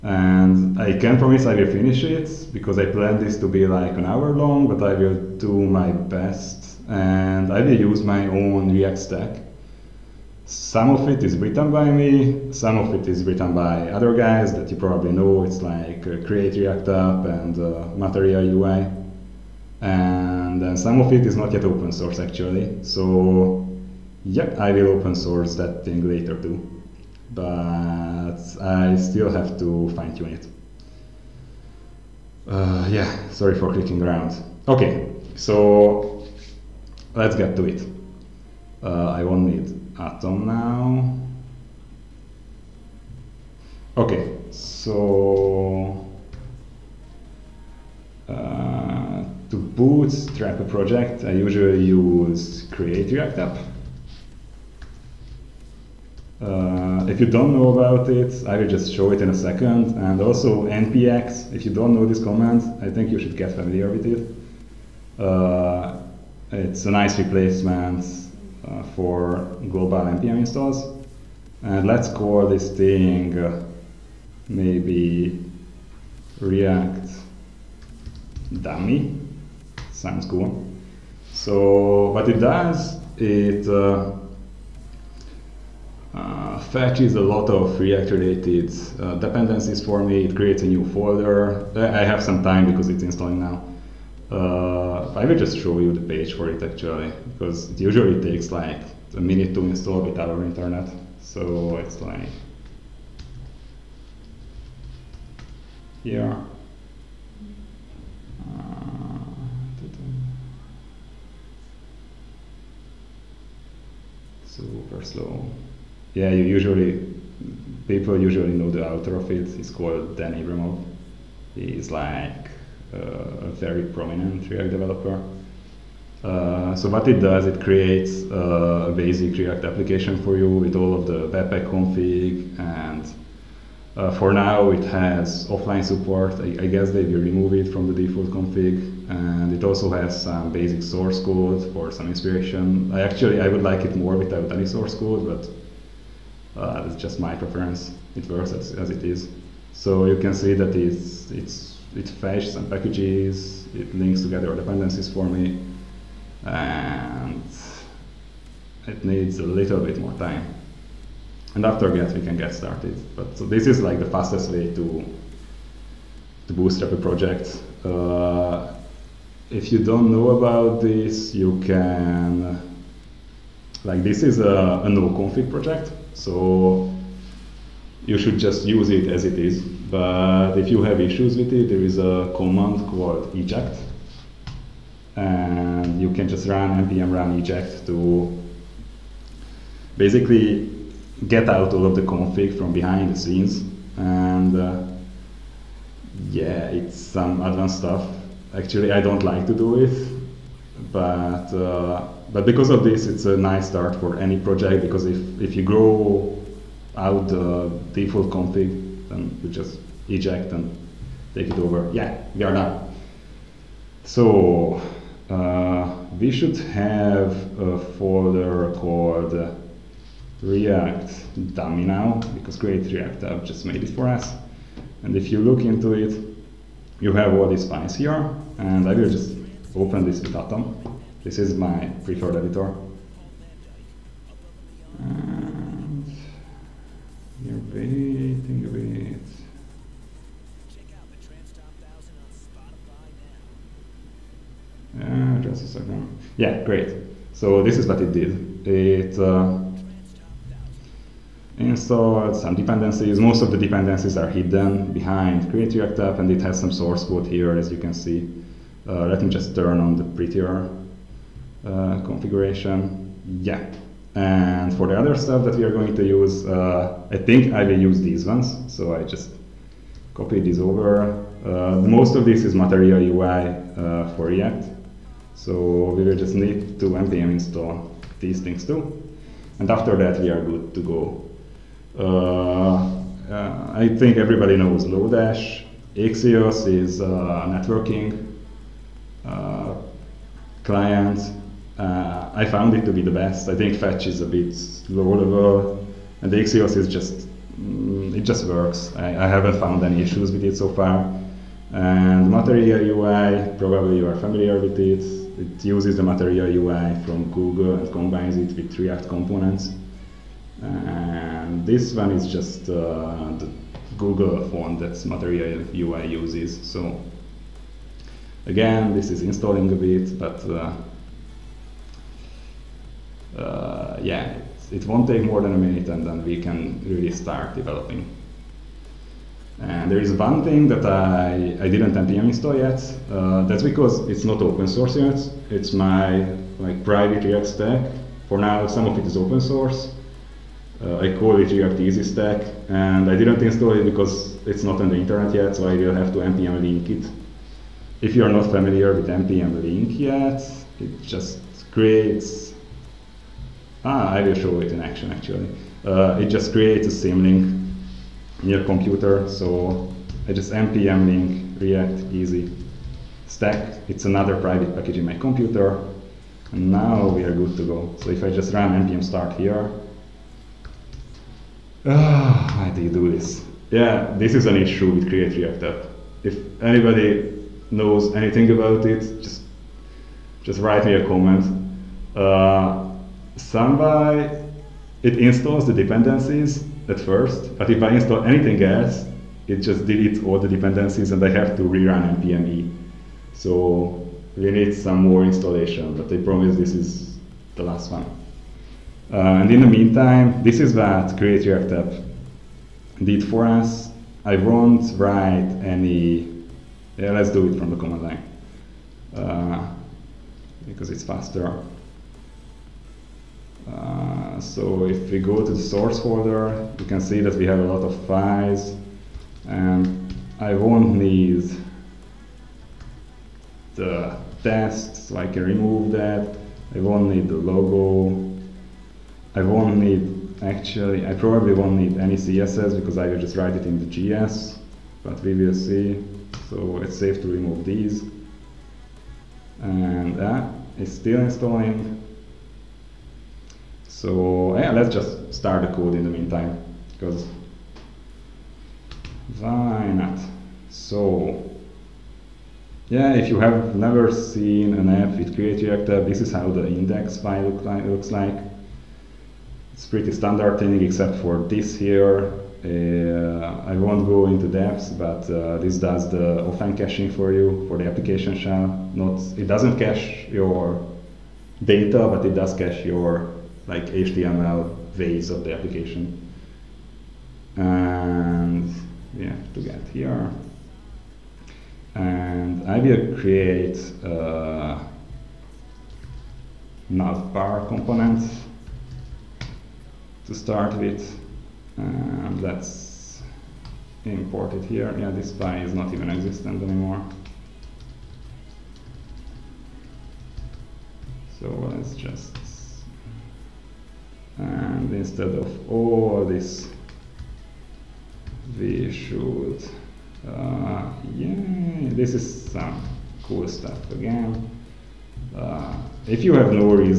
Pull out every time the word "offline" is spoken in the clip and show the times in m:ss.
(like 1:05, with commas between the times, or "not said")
2:15, 7:46.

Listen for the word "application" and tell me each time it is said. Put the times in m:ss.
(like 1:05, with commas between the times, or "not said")
2:09, 7:47, 7:55.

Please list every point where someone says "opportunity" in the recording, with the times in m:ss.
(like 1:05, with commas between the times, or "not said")
not said.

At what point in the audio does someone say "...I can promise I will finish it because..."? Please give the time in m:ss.
0:00.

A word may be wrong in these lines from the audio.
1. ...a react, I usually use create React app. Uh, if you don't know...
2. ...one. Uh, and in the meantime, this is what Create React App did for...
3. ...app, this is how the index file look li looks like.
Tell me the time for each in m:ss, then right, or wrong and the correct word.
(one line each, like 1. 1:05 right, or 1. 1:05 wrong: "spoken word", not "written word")
1. 0:50 wrong: "project", not "react"
2. 6:37 right
3. 7:35 right.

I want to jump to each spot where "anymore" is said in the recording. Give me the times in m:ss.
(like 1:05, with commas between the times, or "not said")
8:16.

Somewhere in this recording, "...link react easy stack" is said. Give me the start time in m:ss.
6:01.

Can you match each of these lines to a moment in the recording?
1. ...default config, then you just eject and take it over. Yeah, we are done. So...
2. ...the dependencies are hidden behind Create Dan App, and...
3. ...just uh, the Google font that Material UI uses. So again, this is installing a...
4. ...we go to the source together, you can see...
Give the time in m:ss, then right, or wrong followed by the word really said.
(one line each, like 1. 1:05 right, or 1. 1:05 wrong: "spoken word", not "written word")
1. 3:27 right
2. 4:13 wrong: "React", not "Dan"
3. 5:12 right
4. 6:55 wrong: "folder", not "together".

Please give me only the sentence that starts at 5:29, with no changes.
And there is one thing that I, I didn't npm install yet.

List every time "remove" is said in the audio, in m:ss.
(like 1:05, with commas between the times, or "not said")
2:17, 7:05, 7:17.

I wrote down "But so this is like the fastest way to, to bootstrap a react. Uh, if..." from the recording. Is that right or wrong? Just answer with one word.
wrong.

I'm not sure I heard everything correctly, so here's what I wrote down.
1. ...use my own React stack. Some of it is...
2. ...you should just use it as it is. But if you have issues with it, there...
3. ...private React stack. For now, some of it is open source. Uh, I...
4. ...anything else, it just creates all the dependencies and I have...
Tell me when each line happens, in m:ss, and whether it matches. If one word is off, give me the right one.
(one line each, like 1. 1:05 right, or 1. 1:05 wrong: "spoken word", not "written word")
1. 0:07 right
2. 2:58 right
3. 5:36 right
4. 6:28 wrong: "deletes", not "creates".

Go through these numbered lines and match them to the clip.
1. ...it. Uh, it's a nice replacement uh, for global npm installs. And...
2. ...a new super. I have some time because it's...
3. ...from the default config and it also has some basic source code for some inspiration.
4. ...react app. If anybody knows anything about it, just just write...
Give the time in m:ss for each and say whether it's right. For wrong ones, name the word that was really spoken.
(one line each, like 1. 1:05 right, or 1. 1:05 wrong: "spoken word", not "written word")
1. 1:04 right
2. 1:30 wrong: "folder", not "super"
3. 2:17 right
4. 6:15 right.